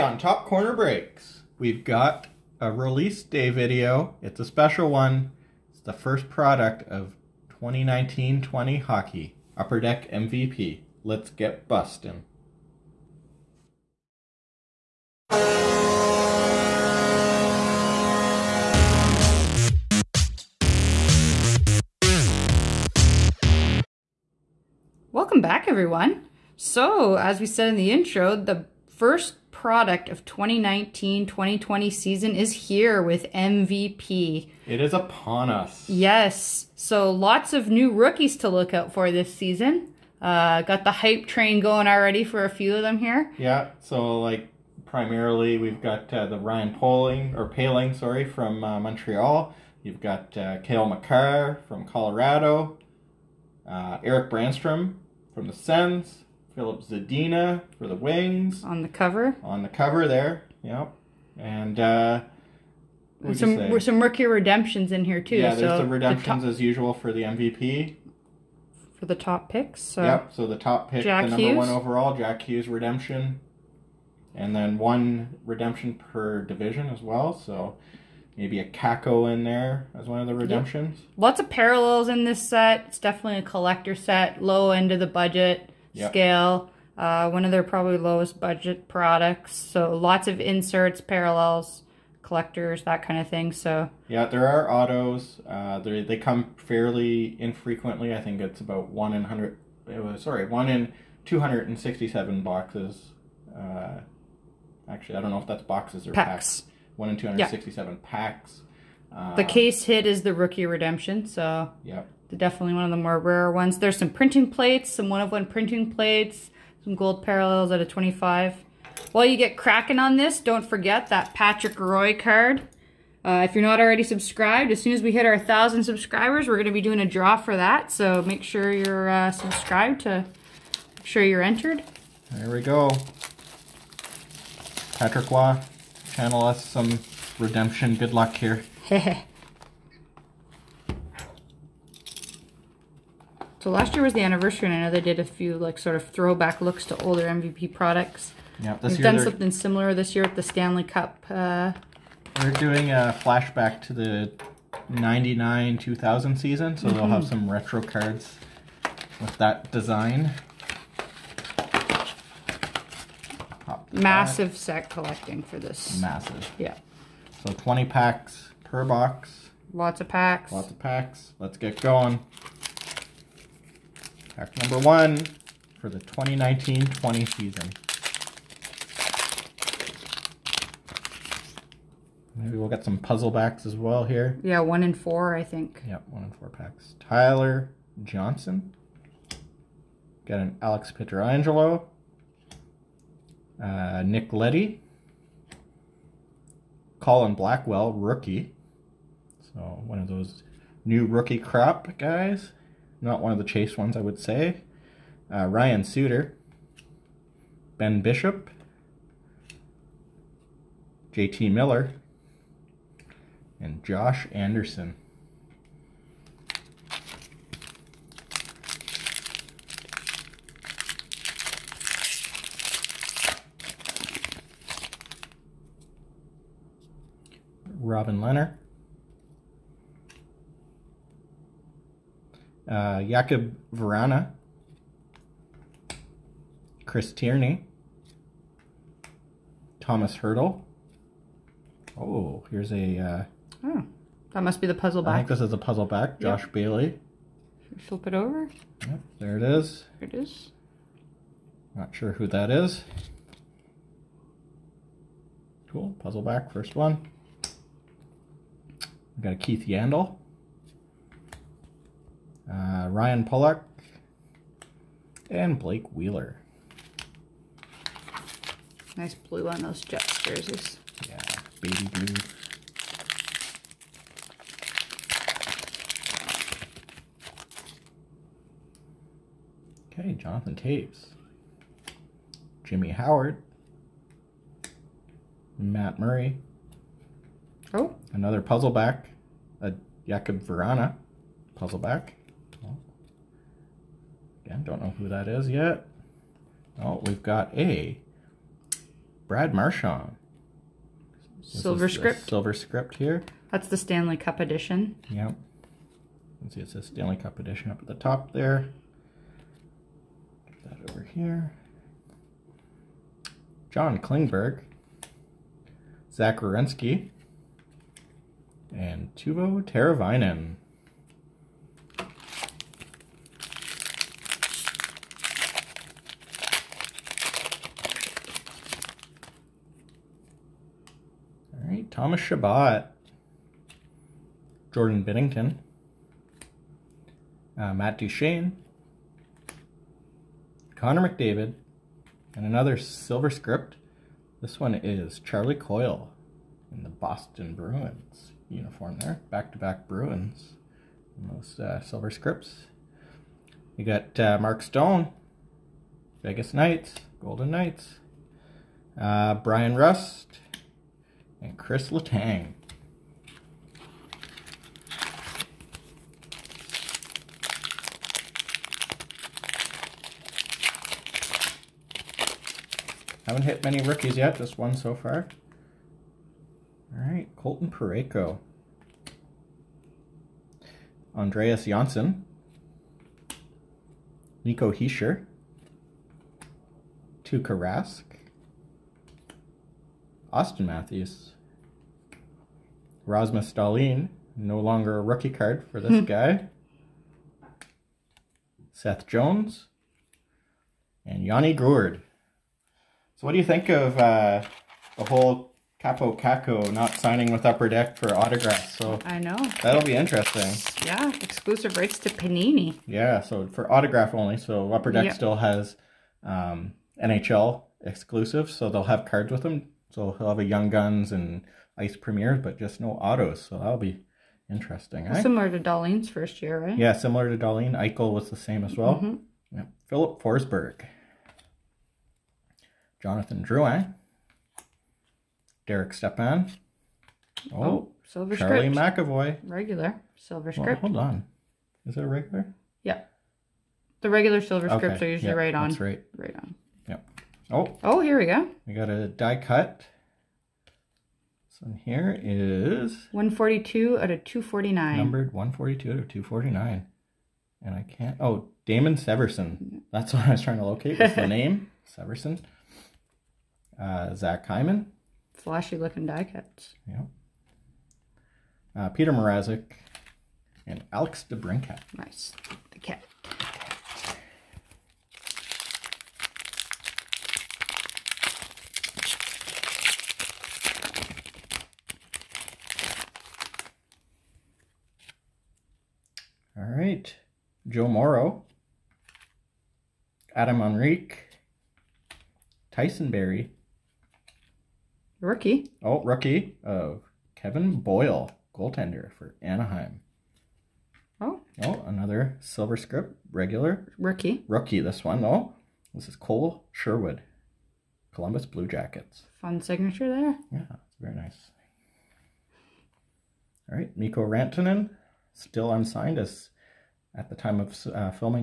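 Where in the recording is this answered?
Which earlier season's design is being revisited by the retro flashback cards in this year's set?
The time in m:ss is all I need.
2:34.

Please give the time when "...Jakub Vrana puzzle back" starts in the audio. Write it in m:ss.
4:50.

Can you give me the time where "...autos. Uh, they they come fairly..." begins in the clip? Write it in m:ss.
1:34.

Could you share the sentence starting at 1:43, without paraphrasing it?
Uh, actually, I don't know if that's boxes or packs.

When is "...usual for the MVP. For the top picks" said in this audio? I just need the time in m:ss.
1:06.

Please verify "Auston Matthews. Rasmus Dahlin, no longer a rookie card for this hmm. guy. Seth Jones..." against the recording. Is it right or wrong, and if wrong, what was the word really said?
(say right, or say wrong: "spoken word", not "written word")
right.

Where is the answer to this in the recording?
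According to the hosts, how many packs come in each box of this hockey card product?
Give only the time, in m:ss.
2:47.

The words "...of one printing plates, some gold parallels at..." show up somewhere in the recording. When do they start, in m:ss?
1:55.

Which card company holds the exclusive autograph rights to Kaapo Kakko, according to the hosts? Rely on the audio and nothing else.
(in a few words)
Panini.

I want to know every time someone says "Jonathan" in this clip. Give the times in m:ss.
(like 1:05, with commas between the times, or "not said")
4:40, 7:13.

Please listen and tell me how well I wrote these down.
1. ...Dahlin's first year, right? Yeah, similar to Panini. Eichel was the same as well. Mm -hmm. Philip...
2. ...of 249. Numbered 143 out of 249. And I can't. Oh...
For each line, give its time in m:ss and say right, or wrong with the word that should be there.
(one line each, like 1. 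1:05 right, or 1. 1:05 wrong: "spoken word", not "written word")
1. 7:05 wrong: "Dahlin", not "Panini"
2. 7:34 wrong: "142", not "143".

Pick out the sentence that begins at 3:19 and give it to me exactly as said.
So one of those new rookie crop guys.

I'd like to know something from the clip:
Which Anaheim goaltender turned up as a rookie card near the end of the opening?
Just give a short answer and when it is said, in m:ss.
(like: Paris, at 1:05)
Kevin Boyle, at 8:17.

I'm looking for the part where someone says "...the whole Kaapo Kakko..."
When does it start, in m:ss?
6:44.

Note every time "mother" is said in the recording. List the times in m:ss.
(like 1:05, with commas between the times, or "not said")
not said.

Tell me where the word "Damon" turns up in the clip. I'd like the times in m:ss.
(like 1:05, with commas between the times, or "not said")
7:38.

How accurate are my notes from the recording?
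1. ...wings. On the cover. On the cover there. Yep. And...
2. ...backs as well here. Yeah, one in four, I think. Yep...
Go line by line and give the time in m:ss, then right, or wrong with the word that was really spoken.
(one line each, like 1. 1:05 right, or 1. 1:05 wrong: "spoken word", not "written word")
1. 0:57 right
2. 3:03 right.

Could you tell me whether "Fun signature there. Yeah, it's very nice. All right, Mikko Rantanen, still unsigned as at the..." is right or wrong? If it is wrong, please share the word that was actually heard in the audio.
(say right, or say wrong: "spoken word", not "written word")
right.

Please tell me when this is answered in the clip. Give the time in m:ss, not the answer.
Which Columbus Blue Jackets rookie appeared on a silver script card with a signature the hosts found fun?
8:26.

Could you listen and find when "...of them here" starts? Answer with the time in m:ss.
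0:42.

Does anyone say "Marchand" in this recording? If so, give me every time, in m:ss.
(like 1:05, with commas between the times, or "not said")
4:59.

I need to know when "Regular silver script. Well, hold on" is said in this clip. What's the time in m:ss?
7:19.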